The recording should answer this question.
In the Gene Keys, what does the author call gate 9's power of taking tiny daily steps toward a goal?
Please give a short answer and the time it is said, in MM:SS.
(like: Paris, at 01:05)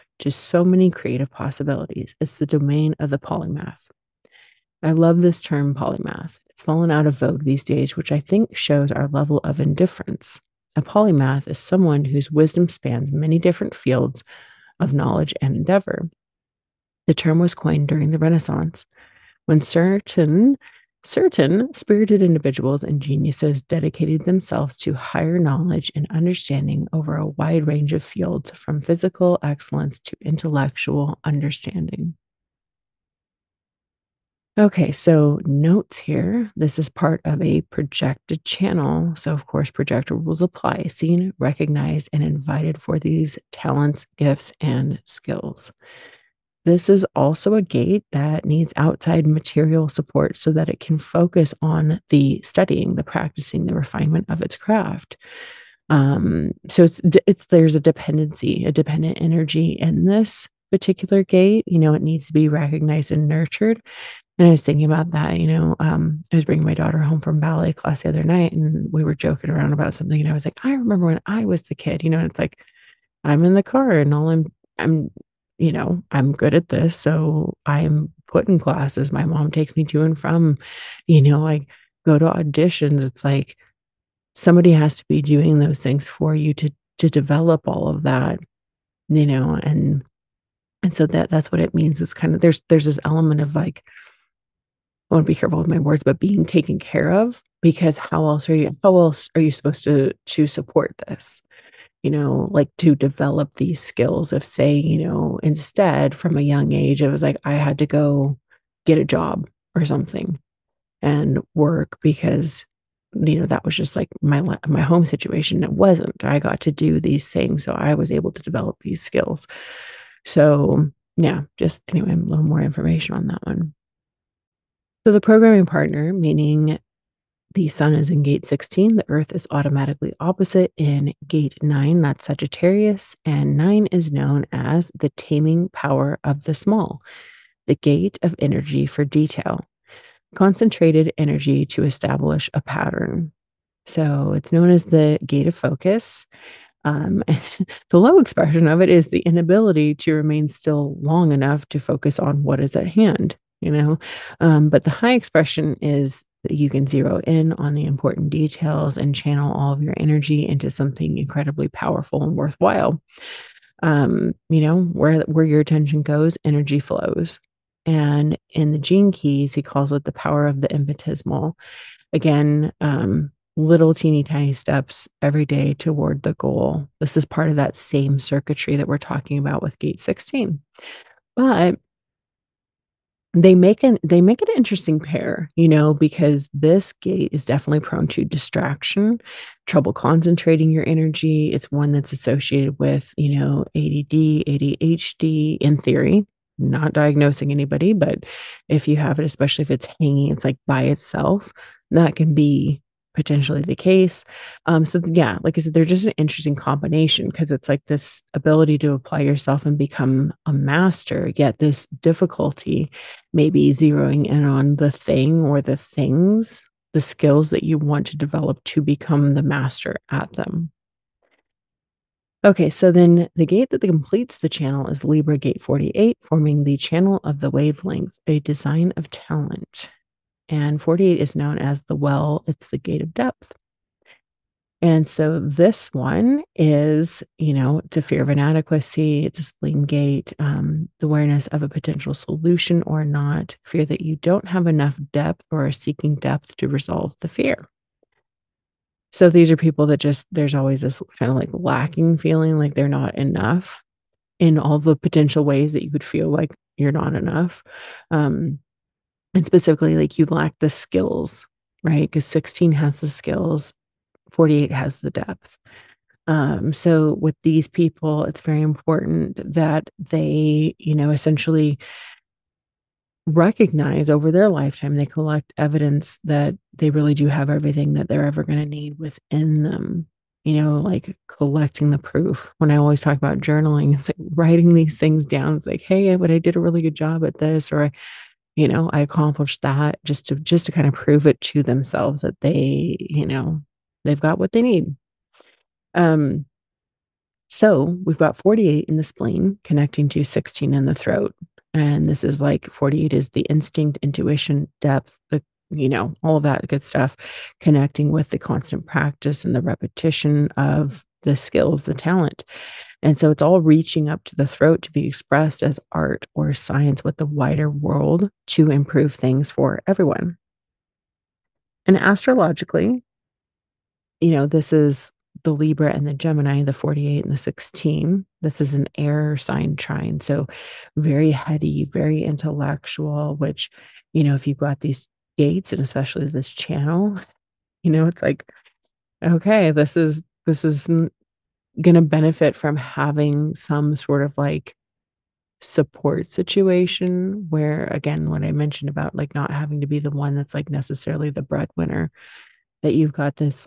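The power of the infinitesimal, at 02:50.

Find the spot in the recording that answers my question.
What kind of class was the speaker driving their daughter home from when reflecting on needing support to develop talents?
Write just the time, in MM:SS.
01:07.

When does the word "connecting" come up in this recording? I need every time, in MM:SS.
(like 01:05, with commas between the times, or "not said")
04:59, 05:07.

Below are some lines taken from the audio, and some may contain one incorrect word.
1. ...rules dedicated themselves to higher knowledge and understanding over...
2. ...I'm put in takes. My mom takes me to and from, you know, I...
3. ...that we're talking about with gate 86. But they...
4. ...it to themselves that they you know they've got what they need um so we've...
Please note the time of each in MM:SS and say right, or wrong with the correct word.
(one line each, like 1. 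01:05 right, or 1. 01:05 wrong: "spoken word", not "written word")
1. 00:23 wrong: "geniuses", not "rules"
2. 01:17 wrong: "classes", not "takes"
3. 02:58 wrong: "16", not "86"
4. 04:51 right.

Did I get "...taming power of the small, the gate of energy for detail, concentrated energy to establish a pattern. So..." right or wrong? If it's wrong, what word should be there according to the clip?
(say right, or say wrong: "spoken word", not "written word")
right.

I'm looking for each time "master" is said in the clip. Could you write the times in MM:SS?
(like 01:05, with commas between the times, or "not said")
03:30, 03:39.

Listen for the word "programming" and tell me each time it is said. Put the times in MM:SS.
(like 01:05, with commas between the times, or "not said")
02:05.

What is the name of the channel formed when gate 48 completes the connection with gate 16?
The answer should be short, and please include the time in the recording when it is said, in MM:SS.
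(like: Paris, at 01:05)
The channel of the wavelength, at 03:46.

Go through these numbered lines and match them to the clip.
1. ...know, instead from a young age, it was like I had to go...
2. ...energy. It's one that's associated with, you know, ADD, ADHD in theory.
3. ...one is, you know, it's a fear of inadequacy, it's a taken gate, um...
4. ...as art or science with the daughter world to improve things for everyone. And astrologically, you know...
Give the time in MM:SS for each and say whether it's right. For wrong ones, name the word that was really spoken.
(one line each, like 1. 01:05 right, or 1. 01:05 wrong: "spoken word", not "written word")
1. 01:45 right
2. 03:10 right
3. 03:55 wrong: "spleen", not "taken"
4. 05:15 wrong: "wider", not "daughter".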